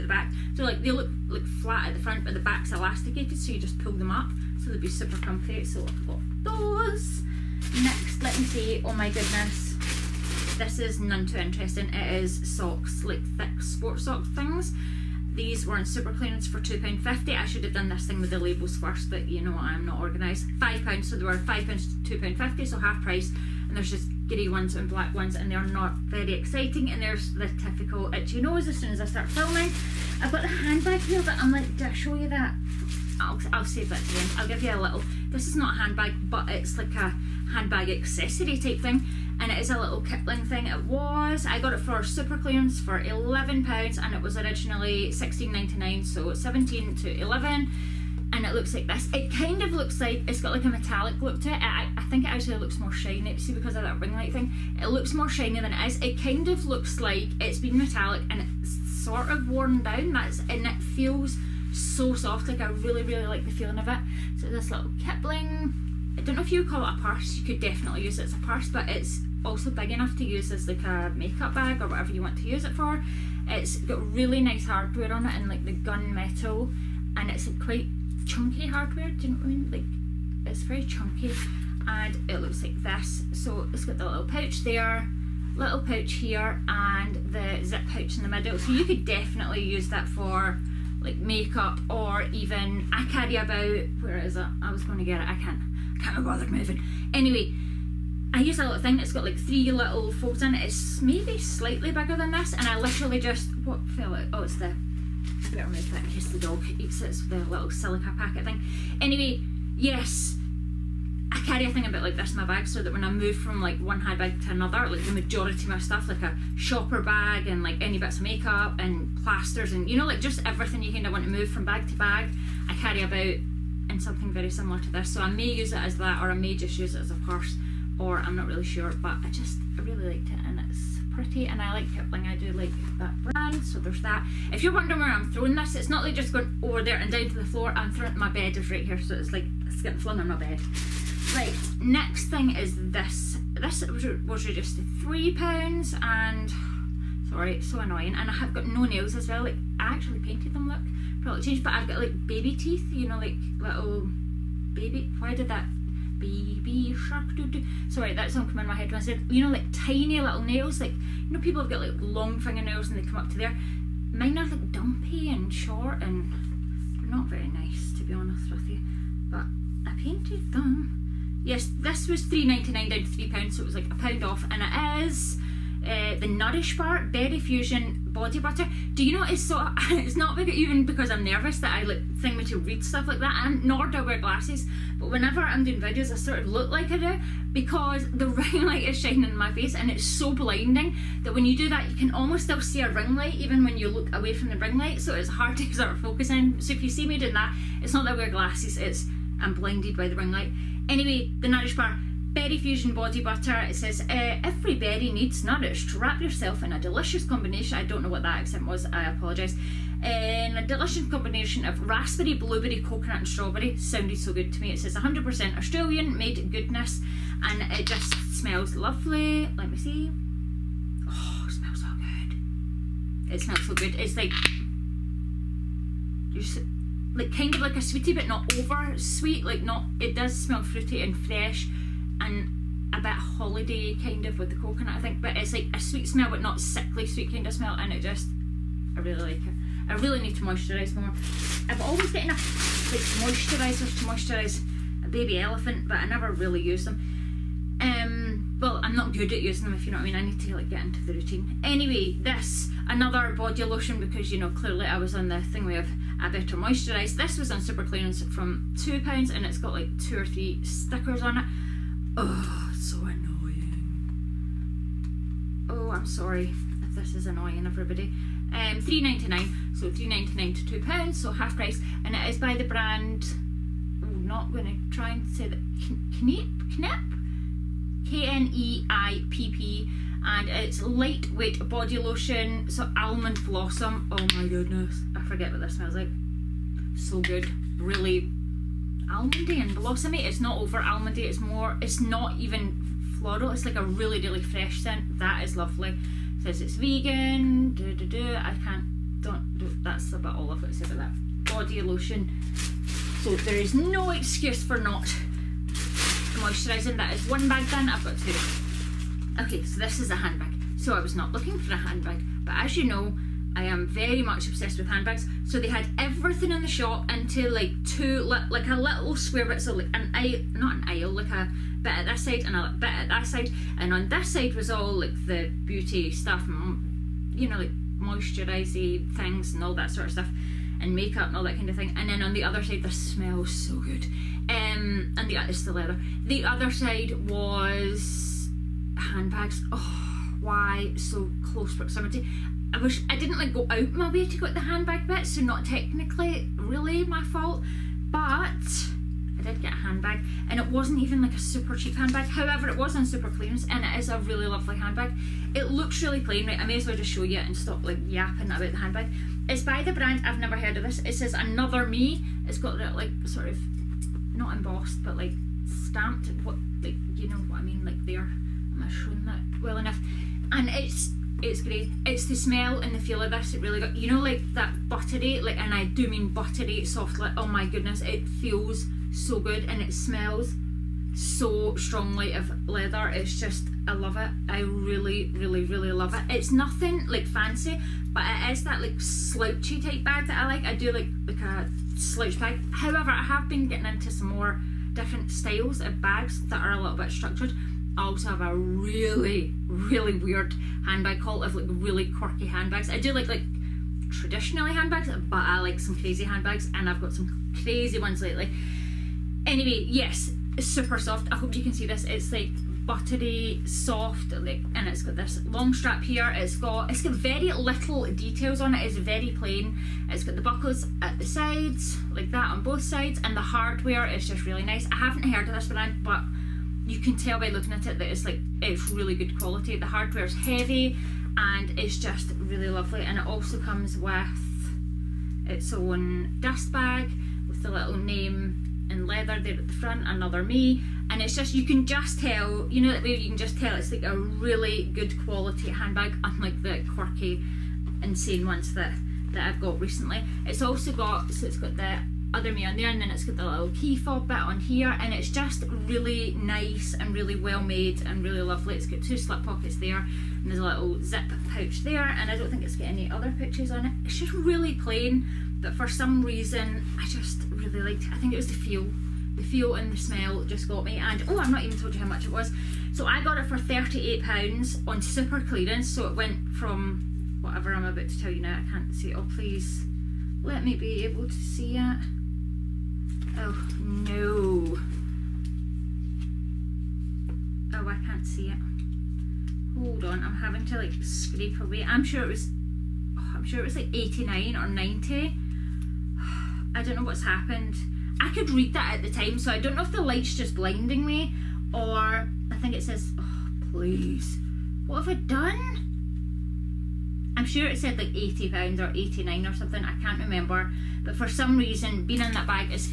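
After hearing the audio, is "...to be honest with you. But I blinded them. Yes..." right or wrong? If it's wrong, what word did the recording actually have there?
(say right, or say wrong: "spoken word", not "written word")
wrong: "painted", not "blinded".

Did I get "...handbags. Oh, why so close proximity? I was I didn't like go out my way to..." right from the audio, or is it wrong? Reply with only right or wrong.
right.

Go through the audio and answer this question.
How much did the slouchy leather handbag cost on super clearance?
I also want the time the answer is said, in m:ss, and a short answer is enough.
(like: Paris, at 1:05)
£38, at 7:53.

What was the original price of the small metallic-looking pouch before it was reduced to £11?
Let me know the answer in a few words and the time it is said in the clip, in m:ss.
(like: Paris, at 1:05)
£16.99, at 0:45.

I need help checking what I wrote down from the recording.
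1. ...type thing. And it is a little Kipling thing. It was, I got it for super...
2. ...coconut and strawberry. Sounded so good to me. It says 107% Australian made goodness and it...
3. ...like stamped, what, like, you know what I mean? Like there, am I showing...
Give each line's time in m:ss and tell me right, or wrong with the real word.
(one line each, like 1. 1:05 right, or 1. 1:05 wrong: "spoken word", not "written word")
1. 0:38 right
2. 3:32 wrong: "100", not "107"
3. 6:05 right.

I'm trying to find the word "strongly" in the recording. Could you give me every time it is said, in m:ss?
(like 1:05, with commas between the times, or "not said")
6:21.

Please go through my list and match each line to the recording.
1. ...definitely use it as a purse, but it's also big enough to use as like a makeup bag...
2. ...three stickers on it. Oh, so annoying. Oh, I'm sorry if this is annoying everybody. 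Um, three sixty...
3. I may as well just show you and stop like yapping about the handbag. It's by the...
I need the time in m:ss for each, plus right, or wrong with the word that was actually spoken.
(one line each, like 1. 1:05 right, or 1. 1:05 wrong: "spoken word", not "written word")
1. 1:07 right
2. 4:20 wrong: "ninety", not "sixty"
3. 5:56 right.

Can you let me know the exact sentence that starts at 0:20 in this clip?
£5, so they were £5 to £2.50, so half price.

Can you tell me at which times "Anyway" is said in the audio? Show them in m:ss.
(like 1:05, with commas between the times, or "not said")
1:37, 1:48, 3:20, 4:11, 6:49.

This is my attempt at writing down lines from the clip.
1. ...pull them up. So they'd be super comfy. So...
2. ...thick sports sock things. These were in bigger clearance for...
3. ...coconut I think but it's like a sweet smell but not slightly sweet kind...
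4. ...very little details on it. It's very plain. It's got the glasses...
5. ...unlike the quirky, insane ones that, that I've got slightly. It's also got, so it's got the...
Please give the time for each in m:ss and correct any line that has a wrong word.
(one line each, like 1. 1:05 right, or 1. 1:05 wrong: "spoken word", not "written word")
1. 0:03 right
2. 0:13 wrong: "super", not "bigger"
3. 3:54 wrong: "sickly", not "slightly"
4. 6:57 wrong: "buckles", not "glasses"
5. 7:26 wrong: "recently", not "slightly".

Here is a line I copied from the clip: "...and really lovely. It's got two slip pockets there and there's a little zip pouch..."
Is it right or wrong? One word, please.
right.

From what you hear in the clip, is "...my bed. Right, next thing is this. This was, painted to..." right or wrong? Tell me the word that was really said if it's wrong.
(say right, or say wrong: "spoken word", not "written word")
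wrong: "reduced", not "painted".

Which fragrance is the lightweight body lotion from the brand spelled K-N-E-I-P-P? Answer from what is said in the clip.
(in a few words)
almond blossom.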